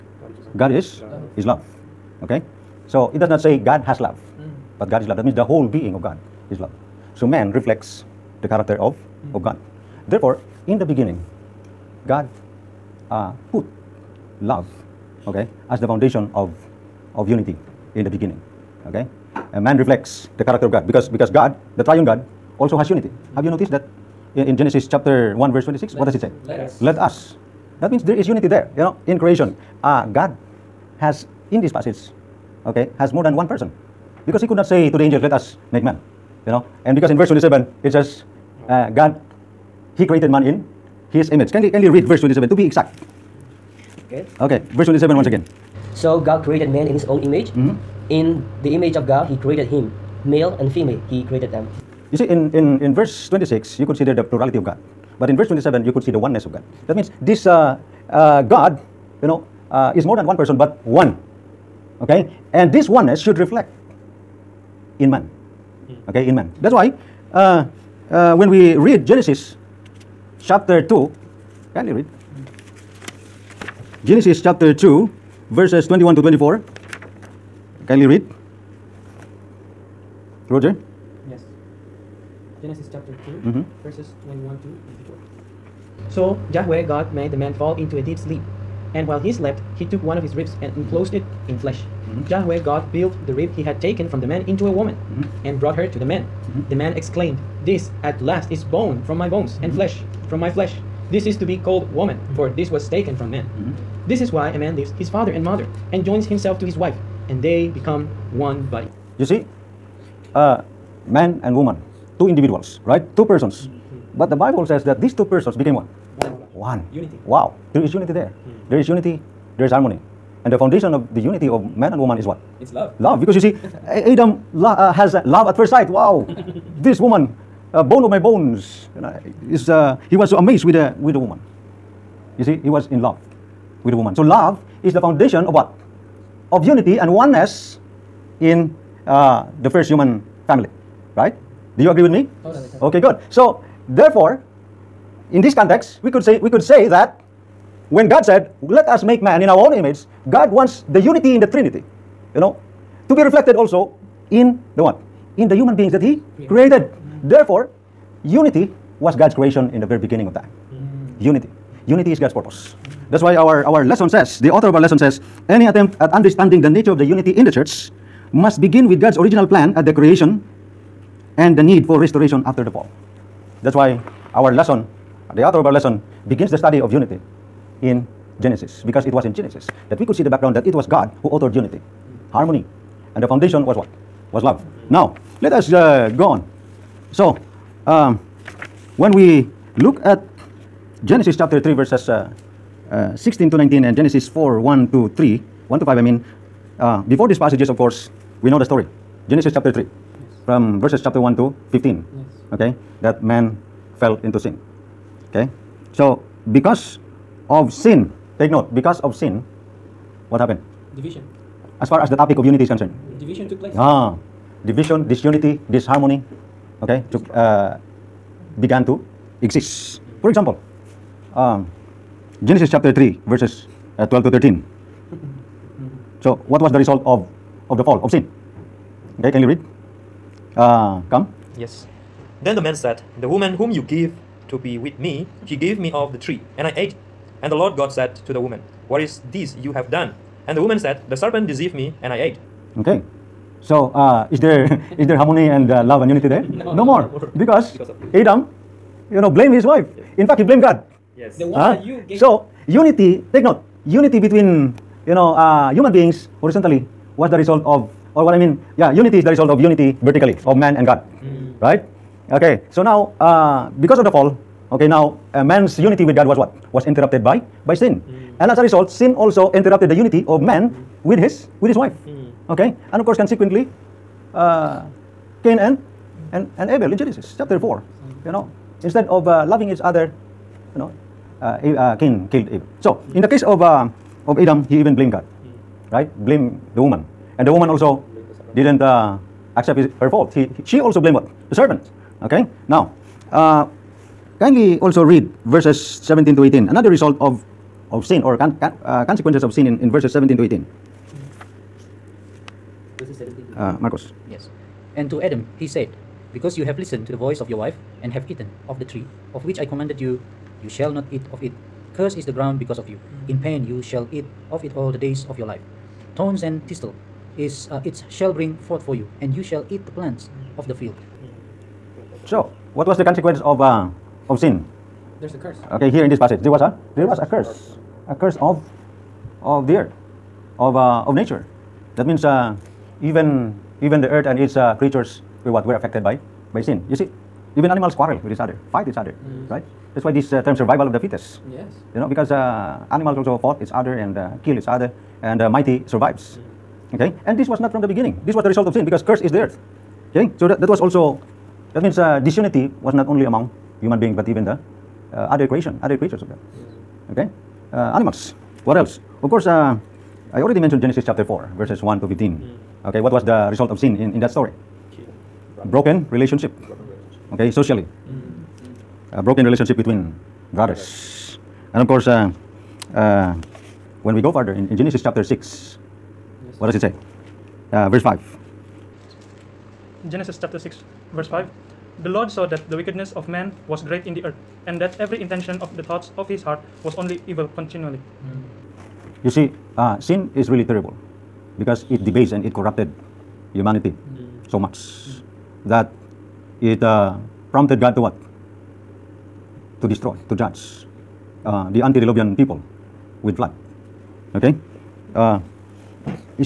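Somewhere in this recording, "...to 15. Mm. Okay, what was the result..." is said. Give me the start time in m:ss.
6:02.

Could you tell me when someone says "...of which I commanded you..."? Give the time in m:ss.
5:09.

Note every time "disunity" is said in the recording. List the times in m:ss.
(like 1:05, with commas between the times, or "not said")
3:35, 5:52.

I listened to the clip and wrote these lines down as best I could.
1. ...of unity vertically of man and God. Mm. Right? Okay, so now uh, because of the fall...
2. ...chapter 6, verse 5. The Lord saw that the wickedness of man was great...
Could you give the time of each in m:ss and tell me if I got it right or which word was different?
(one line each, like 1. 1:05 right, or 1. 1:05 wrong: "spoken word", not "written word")
1. 4:19 right
2. 6:20 right.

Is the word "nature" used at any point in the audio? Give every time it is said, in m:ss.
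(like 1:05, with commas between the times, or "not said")
2:46, 5:31.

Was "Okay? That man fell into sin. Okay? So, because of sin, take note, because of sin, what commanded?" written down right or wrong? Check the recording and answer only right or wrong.
wrong.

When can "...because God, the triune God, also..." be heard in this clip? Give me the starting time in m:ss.
0:21.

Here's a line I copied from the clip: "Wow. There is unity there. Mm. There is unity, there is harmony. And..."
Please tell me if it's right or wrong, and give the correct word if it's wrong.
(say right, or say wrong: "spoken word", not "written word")
right.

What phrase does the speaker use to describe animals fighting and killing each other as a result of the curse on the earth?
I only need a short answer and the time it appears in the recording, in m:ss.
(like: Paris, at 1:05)
Survival of the fittest, at 5:40.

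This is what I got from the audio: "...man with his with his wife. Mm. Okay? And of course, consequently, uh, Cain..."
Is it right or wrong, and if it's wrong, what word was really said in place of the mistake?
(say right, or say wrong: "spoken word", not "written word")
right.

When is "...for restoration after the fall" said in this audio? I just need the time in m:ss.
2:51.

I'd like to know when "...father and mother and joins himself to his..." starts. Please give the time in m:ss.
1:45.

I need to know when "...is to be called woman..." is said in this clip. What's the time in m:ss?
1:41.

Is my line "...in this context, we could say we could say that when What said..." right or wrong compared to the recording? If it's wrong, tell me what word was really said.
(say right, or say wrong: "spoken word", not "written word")
wrong: "God", not "What".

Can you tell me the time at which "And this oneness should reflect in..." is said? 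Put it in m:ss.
1:02.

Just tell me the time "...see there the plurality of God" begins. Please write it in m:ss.
0:53.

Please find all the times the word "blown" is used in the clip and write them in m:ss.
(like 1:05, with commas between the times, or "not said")
not said.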